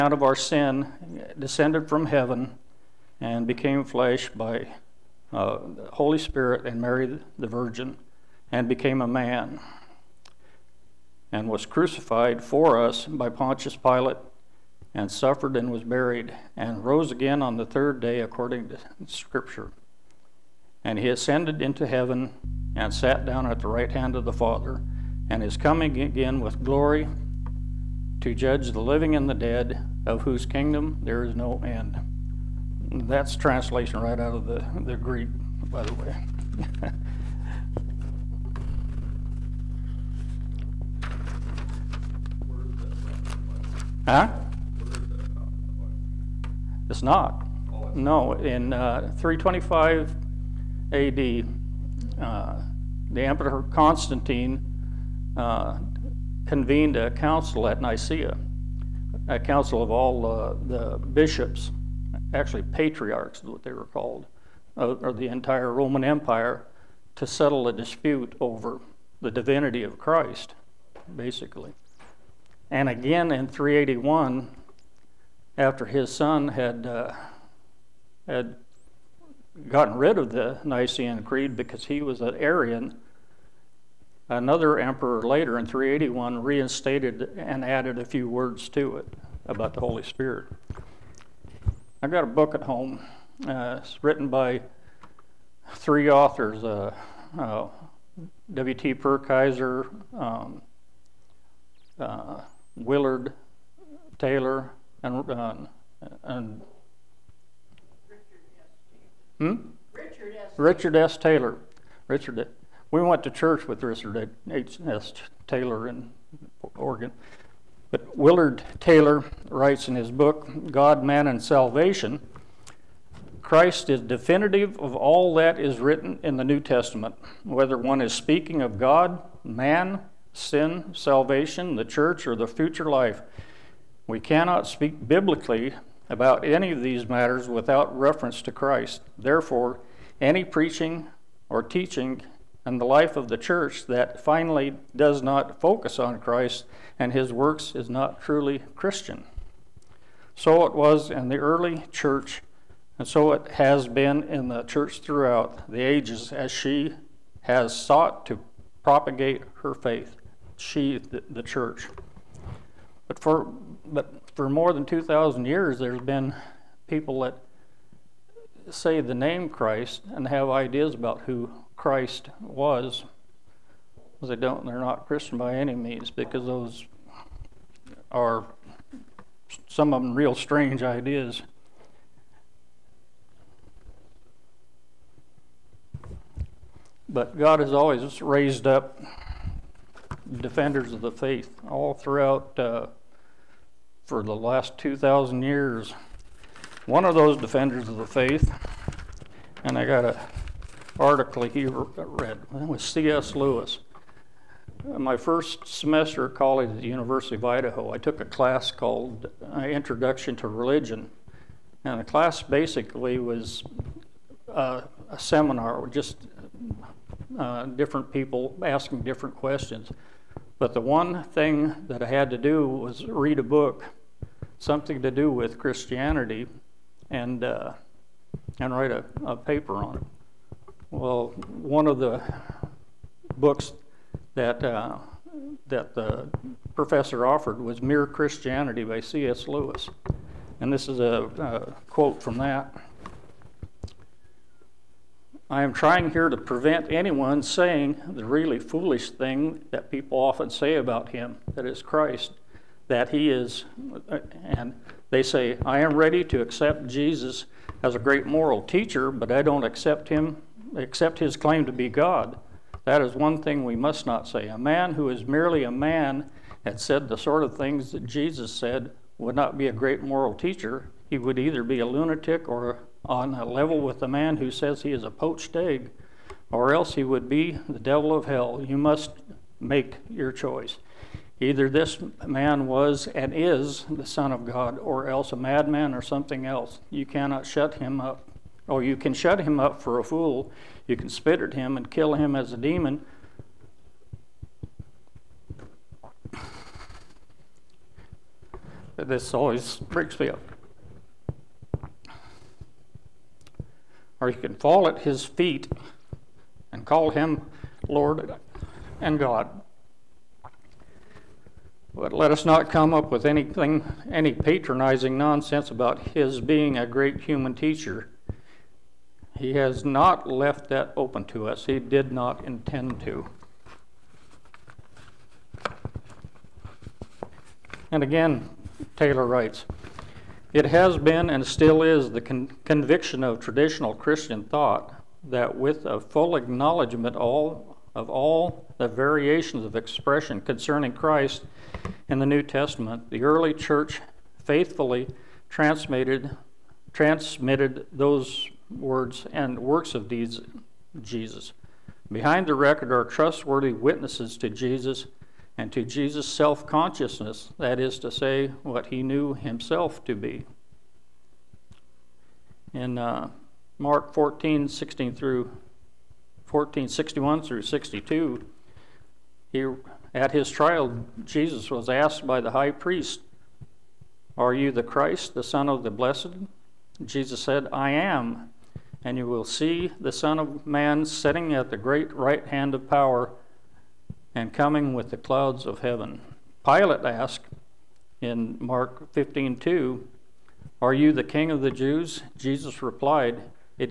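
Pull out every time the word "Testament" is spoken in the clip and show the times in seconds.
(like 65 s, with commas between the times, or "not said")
126 s, 342 s.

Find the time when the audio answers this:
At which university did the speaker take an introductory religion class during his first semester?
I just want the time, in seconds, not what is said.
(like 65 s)
206 s.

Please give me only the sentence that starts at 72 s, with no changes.
And again in 381, after his son had, uh, had gotten rid of the Nicene Creed because he was an Arian.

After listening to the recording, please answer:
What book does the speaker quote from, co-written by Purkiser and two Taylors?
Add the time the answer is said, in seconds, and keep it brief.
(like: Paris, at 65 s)
God, Man, and Salvation, at 120 s.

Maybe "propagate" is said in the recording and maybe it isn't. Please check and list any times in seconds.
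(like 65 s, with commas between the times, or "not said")
158 s.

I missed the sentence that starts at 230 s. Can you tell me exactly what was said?
Well, one of the books that, uh, that the professor offered was Mere Christianity by C.S.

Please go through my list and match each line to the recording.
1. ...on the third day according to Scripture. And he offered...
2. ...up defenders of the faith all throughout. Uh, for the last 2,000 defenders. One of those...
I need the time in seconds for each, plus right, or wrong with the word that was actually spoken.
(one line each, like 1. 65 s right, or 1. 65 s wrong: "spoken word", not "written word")
1. 17 s wrong: "ascended", not "offered"
2. 188 s wrong: "years", not "defenders".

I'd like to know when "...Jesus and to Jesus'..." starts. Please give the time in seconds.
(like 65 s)
354 s.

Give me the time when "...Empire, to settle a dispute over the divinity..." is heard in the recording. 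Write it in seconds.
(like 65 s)
66 s.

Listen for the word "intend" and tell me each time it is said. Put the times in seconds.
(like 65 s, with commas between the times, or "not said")
322 s.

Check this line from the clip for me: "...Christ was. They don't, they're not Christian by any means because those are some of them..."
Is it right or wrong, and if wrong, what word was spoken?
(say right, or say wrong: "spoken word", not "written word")
right.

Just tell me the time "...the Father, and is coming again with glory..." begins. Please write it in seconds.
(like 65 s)
24 s.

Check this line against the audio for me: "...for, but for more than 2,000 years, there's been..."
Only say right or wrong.
right.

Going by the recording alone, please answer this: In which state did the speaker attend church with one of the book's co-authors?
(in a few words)
Oregon.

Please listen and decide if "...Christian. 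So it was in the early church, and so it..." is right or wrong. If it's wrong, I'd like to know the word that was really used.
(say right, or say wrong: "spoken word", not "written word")
right.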